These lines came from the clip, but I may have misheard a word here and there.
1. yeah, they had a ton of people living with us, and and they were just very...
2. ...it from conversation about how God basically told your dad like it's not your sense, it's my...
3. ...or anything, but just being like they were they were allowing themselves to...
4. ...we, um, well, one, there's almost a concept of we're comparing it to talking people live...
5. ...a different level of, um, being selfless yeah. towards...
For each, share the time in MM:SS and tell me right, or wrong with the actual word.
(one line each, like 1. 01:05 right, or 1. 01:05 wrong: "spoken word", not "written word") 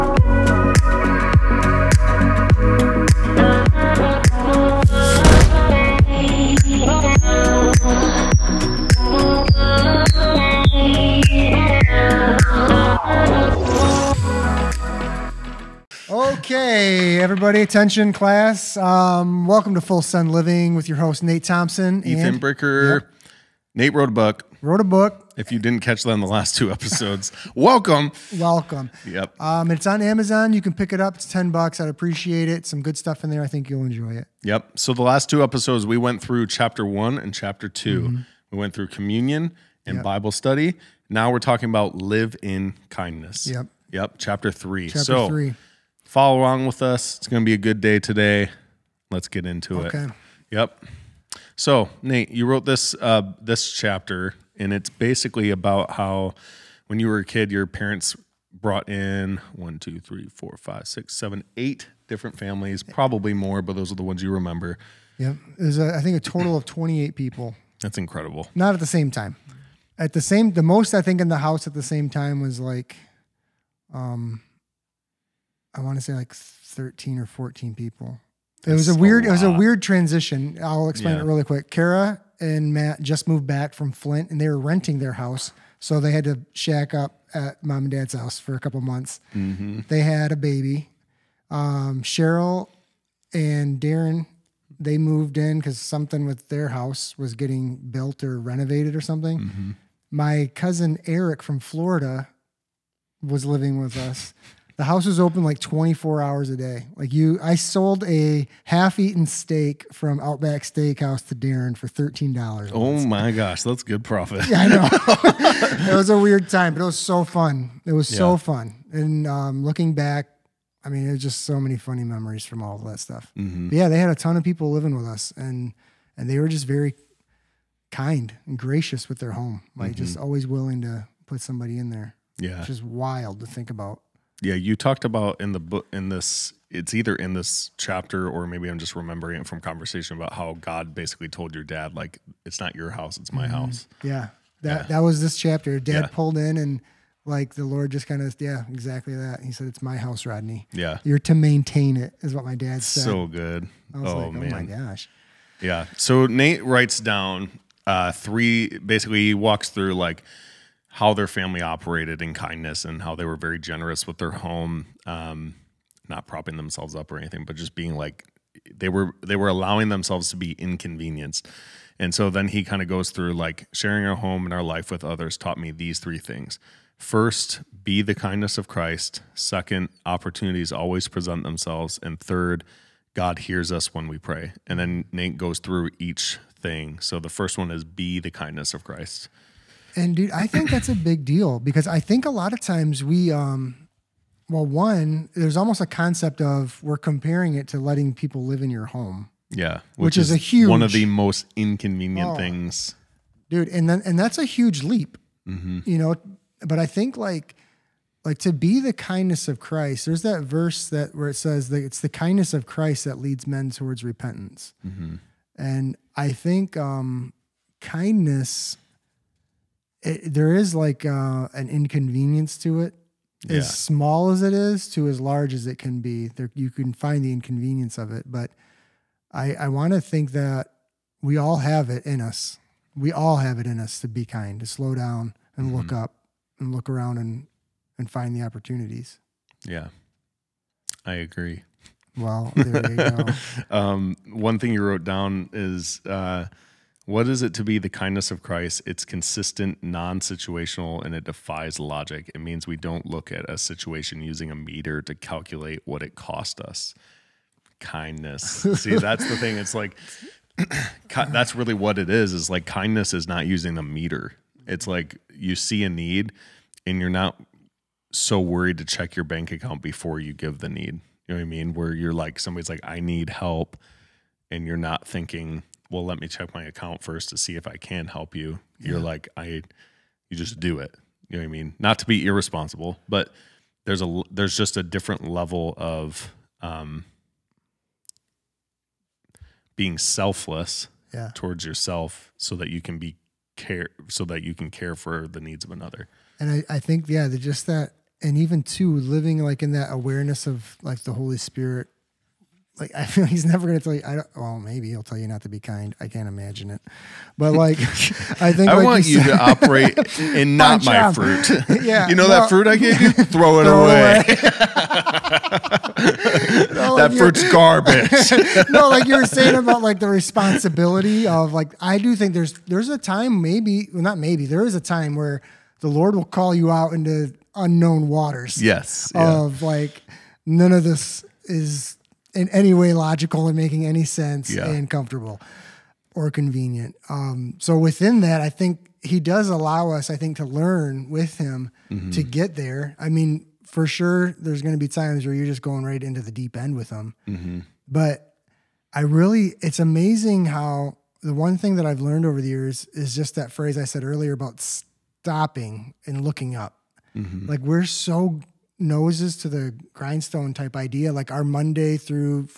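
1. 02:03 right
2. 02:19 wrong: "house", not "sense"
3. 02:47 right
4. 03:13 wrong: "letting", not "talking"
5. 04:44 right.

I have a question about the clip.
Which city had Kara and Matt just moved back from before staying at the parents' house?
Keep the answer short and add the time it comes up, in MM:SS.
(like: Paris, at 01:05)
Flint, at 01:23.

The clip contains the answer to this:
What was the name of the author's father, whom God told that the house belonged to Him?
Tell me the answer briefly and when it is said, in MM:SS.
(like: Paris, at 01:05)
Rodney, at 02:30.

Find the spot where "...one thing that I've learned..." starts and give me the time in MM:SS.
05:51.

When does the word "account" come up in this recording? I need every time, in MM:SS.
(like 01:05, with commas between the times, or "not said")
04:29, 04:36.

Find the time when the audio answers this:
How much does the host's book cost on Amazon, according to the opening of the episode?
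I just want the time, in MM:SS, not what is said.
00:31.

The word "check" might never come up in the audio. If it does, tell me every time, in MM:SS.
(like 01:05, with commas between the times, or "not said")
04:28, 04:36.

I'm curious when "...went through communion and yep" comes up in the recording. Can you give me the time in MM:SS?
00:38.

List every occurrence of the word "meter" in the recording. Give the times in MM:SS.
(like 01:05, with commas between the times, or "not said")
04:14, 04:23.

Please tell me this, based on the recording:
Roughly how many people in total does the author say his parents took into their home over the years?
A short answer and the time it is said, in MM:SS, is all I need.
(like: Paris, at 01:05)
28, at 01:06.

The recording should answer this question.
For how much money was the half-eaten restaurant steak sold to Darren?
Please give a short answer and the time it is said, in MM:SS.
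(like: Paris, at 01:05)
$13, at 01:51.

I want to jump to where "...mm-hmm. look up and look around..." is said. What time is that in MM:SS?
03:55.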